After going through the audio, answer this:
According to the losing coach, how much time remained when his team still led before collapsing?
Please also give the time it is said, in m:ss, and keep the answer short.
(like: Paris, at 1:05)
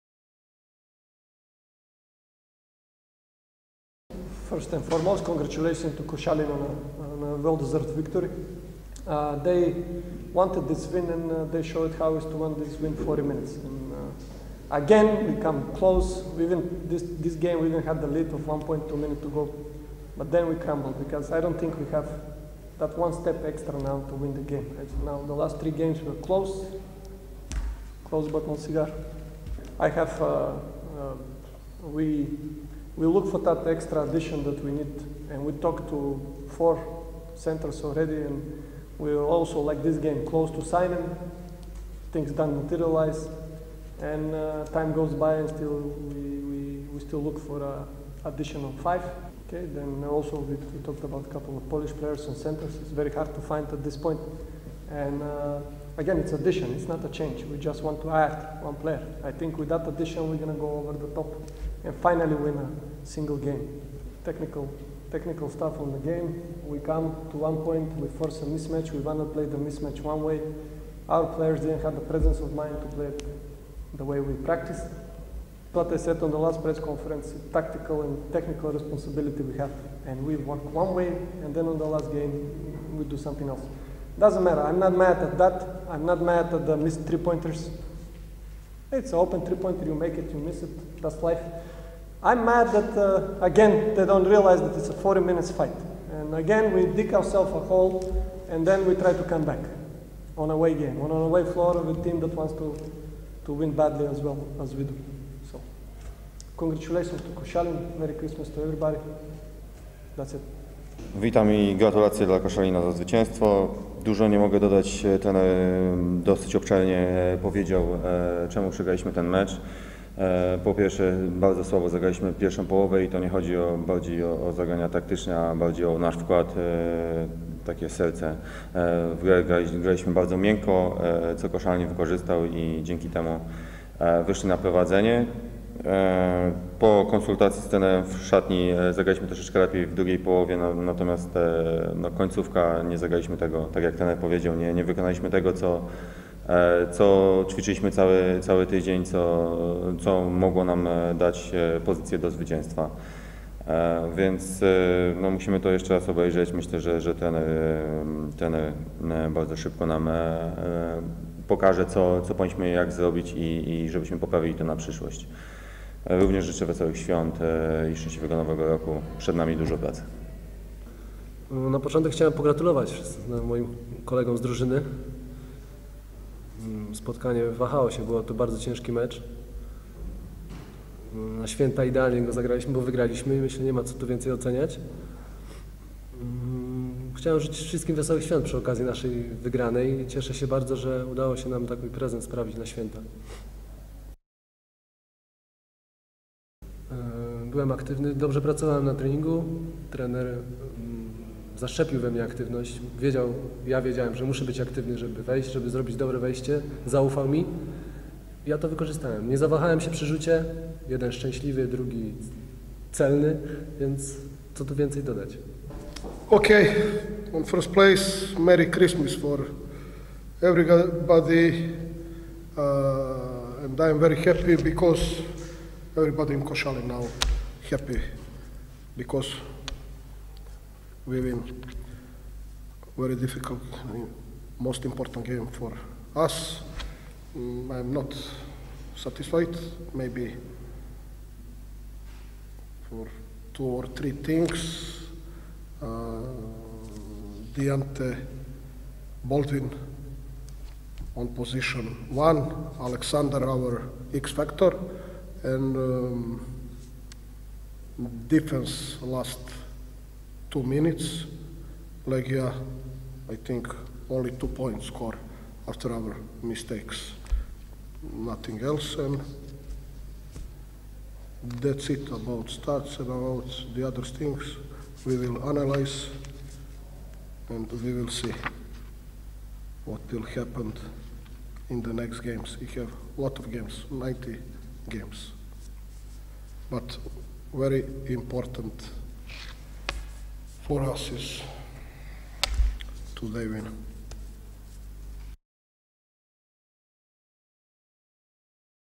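1.2 minutes, at 0:18.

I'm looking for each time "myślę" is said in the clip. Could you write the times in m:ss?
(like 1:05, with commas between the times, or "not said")
2:36, 3:03.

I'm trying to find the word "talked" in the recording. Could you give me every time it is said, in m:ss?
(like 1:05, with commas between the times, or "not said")
0:35, 0:50.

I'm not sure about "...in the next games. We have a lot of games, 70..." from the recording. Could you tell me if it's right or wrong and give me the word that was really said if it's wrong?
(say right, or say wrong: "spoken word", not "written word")
wrong: "90", not "70".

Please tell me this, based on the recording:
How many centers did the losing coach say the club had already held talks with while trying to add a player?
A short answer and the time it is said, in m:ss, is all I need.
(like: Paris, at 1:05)
4, at 0:36.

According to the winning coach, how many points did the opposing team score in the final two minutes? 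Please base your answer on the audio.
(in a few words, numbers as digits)
2.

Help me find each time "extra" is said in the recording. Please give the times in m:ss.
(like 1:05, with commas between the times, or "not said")
0:23, 0:33.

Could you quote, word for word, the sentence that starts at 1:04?
Technical, technical stuff on the game.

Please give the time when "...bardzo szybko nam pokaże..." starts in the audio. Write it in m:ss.
2:39.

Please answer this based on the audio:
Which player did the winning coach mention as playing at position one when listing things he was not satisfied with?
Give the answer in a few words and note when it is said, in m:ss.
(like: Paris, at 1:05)
Deante Baldwin, at 4:07.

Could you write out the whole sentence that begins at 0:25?
now the last three games were close, close but not cigar.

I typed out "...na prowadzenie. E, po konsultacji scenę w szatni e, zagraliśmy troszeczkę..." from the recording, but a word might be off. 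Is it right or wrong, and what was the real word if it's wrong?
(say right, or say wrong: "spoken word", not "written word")
right.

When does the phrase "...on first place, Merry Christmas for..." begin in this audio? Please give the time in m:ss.
3:37.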